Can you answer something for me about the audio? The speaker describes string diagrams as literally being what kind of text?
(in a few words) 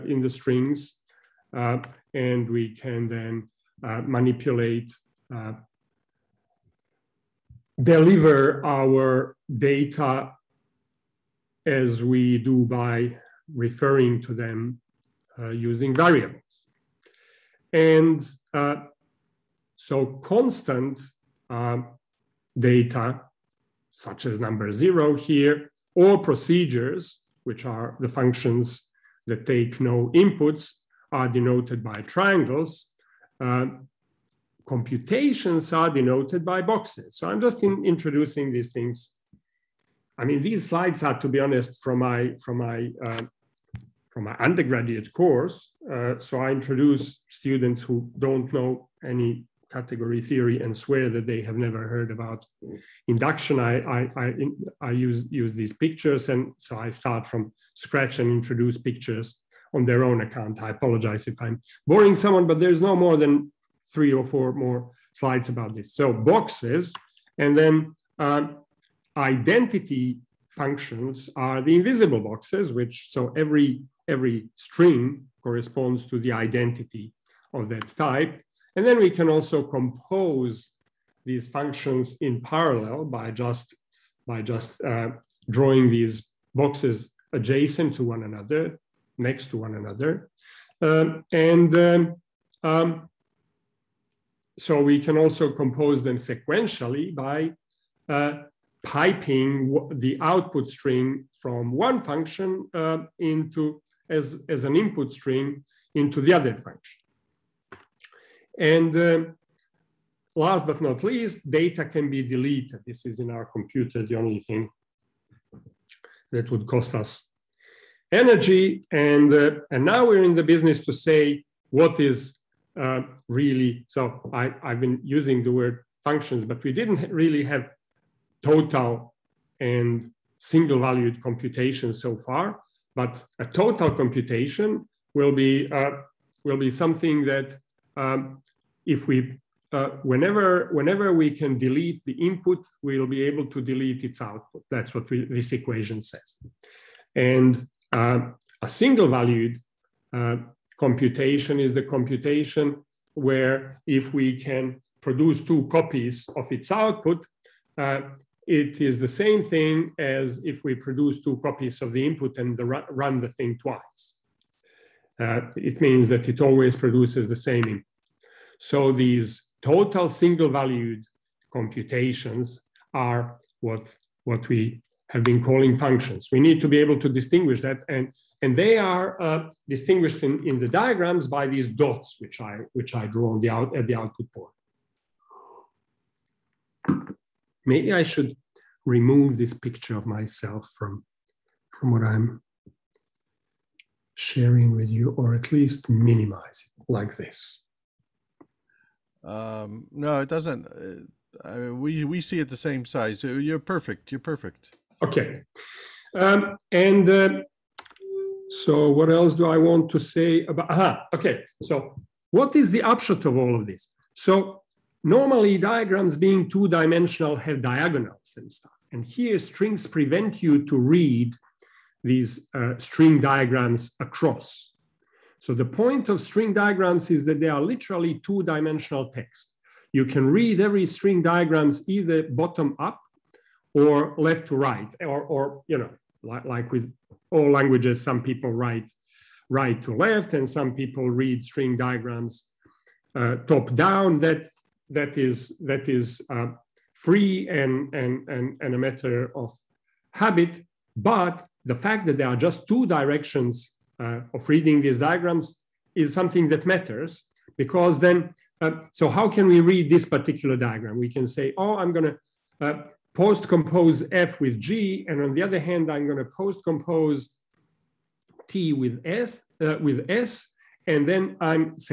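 Two-dimensional text.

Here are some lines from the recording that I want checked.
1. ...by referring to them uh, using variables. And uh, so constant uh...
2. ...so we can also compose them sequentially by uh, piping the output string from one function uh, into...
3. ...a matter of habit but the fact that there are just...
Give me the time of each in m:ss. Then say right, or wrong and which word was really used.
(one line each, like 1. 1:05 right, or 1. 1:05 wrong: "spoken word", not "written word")
1. 0:12 right
2. 1:34 right
3. 4:08 right.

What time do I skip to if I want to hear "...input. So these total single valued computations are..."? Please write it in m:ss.
2:47.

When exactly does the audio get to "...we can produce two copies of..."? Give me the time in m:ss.
2:34.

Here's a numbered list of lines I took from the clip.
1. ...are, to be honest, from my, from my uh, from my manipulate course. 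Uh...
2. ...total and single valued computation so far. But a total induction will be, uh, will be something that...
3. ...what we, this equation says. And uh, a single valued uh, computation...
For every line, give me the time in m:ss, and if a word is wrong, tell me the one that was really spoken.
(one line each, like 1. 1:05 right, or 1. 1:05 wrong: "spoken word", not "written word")
1. 0:41 wrong: "undergraduate", not "manipulate"
2. 2:08 wrong: "computation", not "induction"
3. 2:24 right.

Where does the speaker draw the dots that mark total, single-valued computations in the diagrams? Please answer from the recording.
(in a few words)
At the output port.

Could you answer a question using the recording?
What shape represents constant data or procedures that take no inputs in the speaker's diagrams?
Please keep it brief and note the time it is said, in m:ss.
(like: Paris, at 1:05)
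Triangles, at 0:32.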